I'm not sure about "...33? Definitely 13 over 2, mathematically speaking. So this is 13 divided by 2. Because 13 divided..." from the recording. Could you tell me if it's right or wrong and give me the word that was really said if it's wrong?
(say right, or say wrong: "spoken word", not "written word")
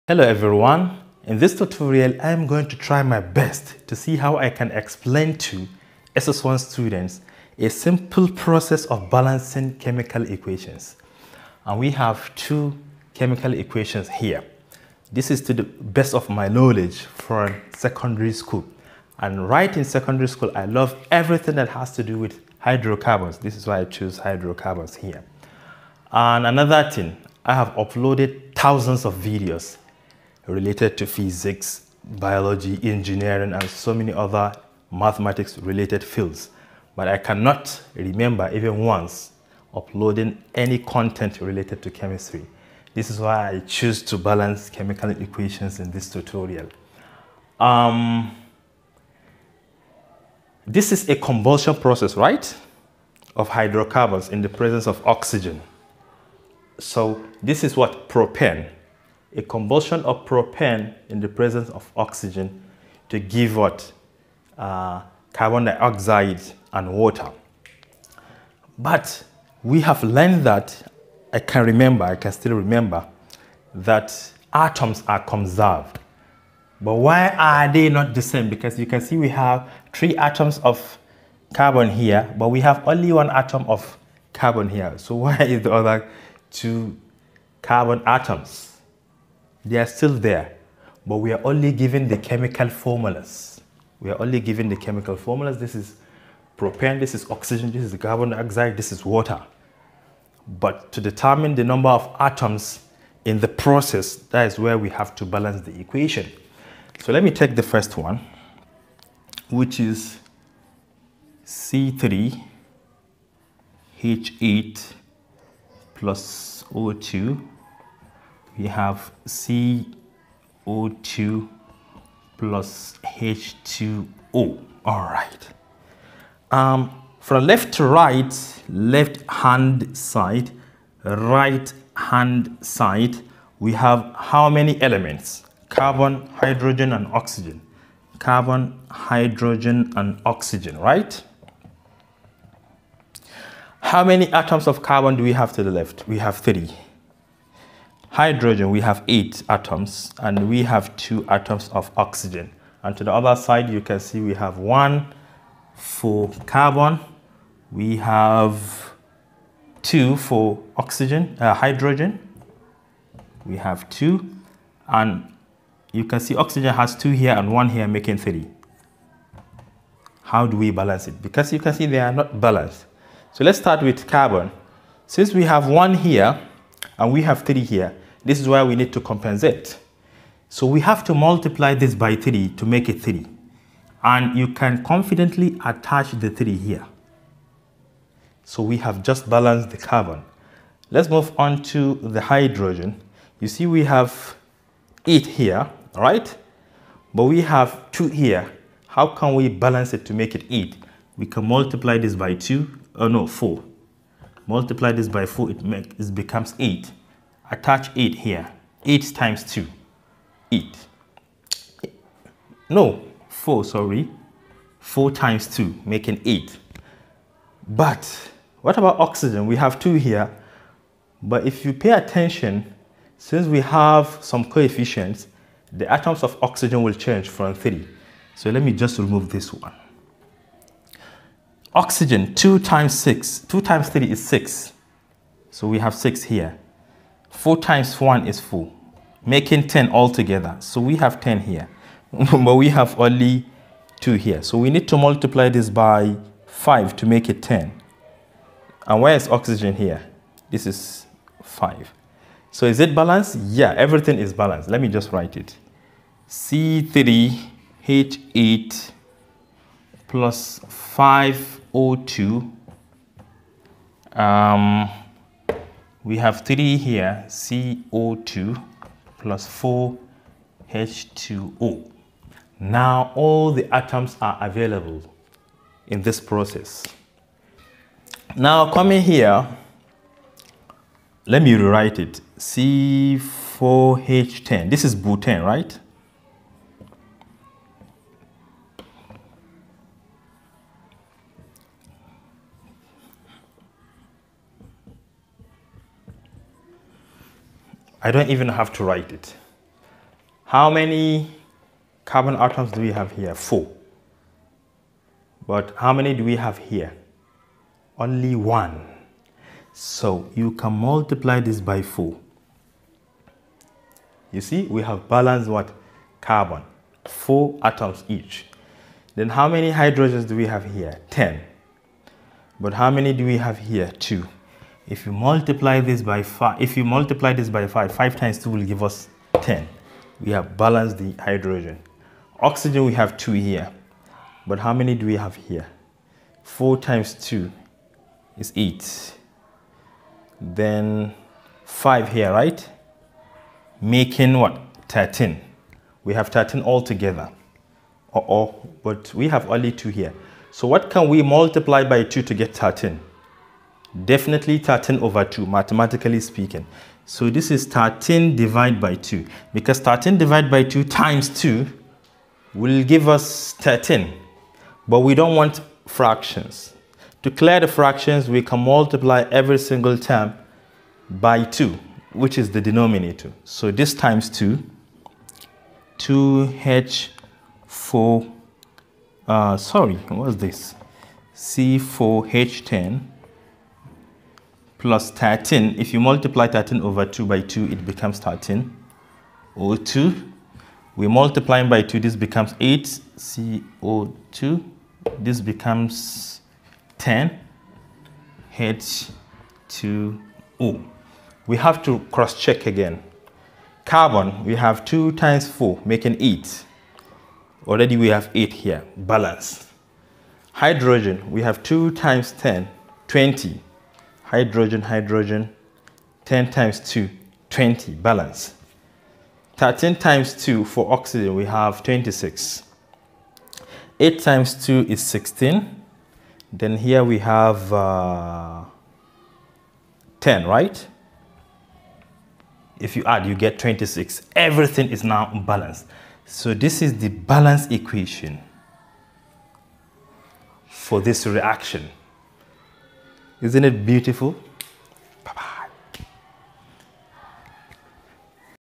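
wrong: "13", not "33".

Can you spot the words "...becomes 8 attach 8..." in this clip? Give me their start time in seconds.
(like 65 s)
206 s.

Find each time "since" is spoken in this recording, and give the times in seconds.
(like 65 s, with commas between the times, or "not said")
175 s, 223 s.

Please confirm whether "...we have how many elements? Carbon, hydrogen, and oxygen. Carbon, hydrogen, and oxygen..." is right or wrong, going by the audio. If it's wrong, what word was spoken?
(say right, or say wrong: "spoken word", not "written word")
right.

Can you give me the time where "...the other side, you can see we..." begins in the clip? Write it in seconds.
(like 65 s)
153 s.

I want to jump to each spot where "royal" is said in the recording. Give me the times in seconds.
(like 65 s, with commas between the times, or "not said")
not said.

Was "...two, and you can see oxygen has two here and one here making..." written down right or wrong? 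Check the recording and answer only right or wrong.
right.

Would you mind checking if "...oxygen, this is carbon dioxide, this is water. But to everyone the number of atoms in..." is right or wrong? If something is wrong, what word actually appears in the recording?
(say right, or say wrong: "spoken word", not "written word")
wrong: "determine", not "everyone".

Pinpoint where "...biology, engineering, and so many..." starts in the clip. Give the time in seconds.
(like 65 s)
32 s.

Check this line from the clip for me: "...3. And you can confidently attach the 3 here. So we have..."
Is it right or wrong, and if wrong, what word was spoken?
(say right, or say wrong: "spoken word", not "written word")
right.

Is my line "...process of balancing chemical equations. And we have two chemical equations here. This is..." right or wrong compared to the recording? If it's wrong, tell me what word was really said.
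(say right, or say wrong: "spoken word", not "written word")
right.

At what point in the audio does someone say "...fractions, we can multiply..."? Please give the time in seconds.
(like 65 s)
367 s.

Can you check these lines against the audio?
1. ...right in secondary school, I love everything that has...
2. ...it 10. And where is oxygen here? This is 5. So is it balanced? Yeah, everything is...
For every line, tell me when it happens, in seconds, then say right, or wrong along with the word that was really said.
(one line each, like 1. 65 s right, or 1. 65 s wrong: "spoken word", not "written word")
1. 19 s right
2. 247 s right.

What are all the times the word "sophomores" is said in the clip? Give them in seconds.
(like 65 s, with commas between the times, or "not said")
not said.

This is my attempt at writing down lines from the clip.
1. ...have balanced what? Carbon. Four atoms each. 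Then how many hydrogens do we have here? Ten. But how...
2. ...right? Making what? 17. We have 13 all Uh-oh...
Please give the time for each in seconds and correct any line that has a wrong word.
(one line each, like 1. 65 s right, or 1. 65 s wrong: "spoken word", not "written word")
1. 314 s right
2. 342 s wrong: "13", not "17".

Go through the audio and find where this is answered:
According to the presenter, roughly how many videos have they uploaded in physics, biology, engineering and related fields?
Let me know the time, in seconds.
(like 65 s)
28 s.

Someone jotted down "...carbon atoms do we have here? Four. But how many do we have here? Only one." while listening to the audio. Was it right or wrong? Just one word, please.
right.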